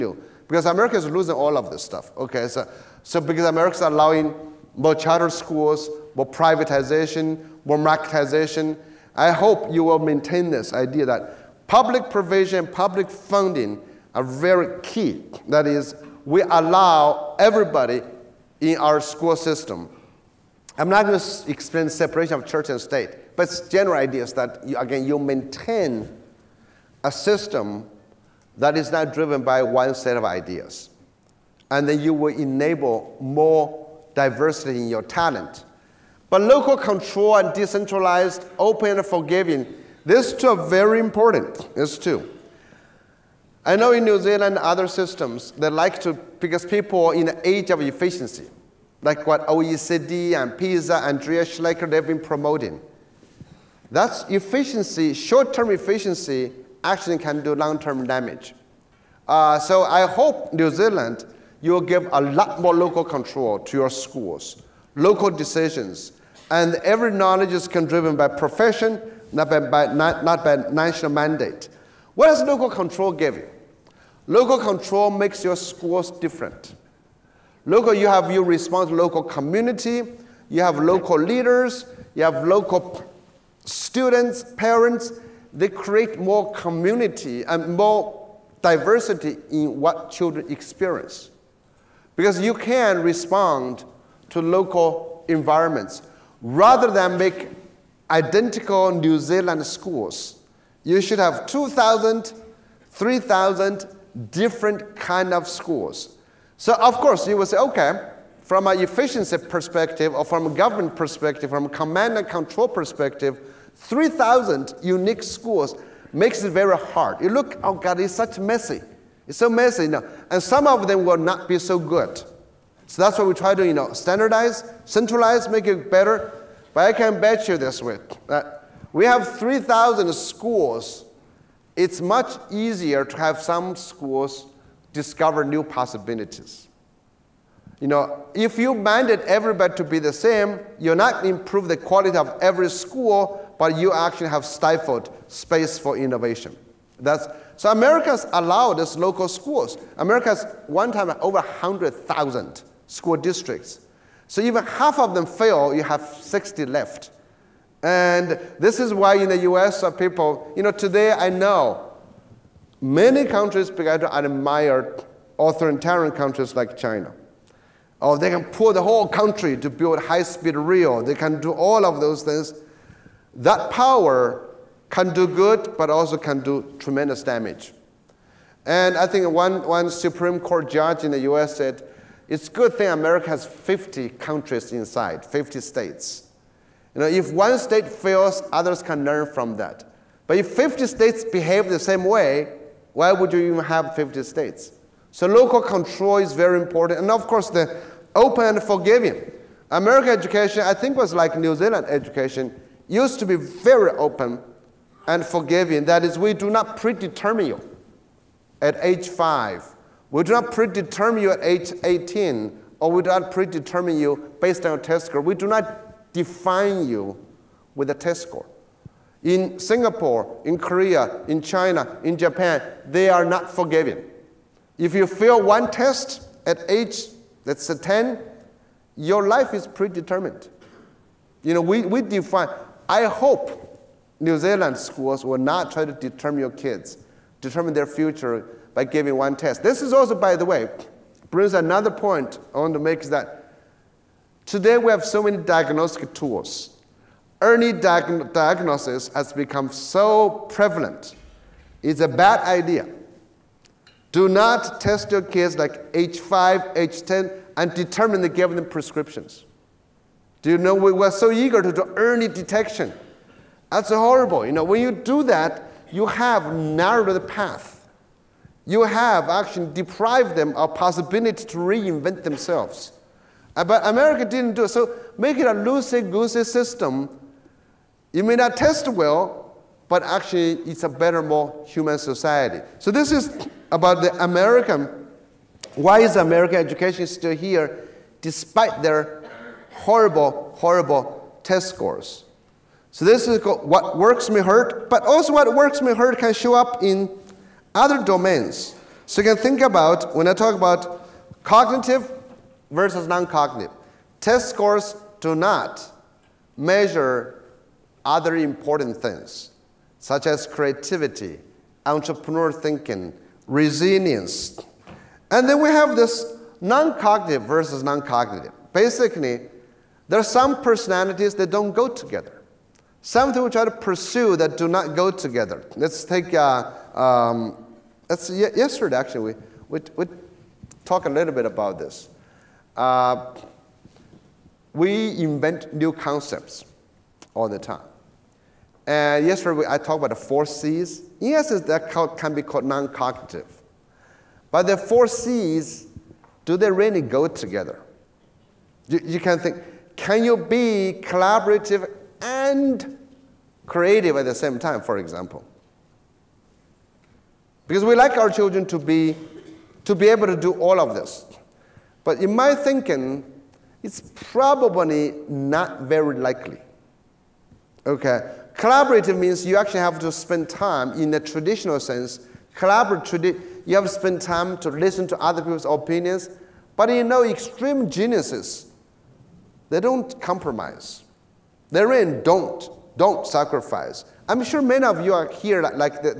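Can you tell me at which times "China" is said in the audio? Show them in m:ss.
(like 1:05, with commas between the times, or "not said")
2:46, 3:41.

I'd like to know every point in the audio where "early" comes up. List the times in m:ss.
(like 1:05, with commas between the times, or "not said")
4:07, 4:21.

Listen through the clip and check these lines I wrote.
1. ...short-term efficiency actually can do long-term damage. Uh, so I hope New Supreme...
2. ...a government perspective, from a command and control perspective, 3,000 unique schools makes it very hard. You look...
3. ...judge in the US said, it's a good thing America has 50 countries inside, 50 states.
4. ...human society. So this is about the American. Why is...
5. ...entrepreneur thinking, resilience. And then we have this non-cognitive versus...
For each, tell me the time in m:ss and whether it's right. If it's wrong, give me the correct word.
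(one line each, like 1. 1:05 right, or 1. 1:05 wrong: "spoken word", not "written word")
1. 0:55 wrong: "Zealand", not "Supreme"
2. 1:50 right
3. 3:00 right
4. 4:41 right
5. 5:11 right.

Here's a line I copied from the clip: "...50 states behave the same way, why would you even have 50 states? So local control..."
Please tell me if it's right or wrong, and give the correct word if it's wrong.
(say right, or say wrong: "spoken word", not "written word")
right.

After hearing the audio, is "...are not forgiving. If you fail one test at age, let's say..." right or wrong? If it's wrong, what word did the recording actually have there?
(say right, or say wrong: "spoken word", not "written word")
right.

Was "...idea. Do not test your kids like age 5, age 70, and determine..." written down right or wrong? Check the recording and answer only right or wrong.
wrong.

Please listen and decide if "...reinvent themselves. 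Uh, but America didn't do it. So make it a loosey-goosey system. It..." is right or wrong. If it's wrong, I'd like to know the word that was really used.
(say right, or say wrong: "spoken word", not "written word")
right.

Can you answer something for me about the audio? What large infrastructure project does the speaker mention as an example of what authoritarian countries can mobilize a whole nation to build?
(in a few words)
High-speed rail.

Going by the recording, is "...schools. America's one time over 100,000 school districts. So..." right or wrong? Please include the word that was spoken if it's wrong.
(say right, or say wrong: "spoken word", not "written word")
right.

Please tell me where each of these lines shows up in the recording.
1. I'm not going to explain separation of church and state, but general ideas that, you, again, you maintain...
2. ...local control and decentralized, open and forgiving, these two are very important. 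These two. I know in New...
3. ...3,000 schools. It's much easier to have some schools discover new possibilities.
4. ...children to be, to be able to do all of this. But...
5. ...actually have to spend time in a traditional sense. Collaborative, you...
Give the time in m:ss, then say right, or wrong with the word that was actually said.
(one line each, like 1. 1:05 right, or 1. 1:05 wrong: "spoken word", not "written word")
1. 0:20 right
2. 0:36 right
3. 2:09 right
4. 5:58 right
5. 6:09 right.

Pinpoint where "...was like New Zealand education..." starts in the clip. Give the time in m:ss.
3:20.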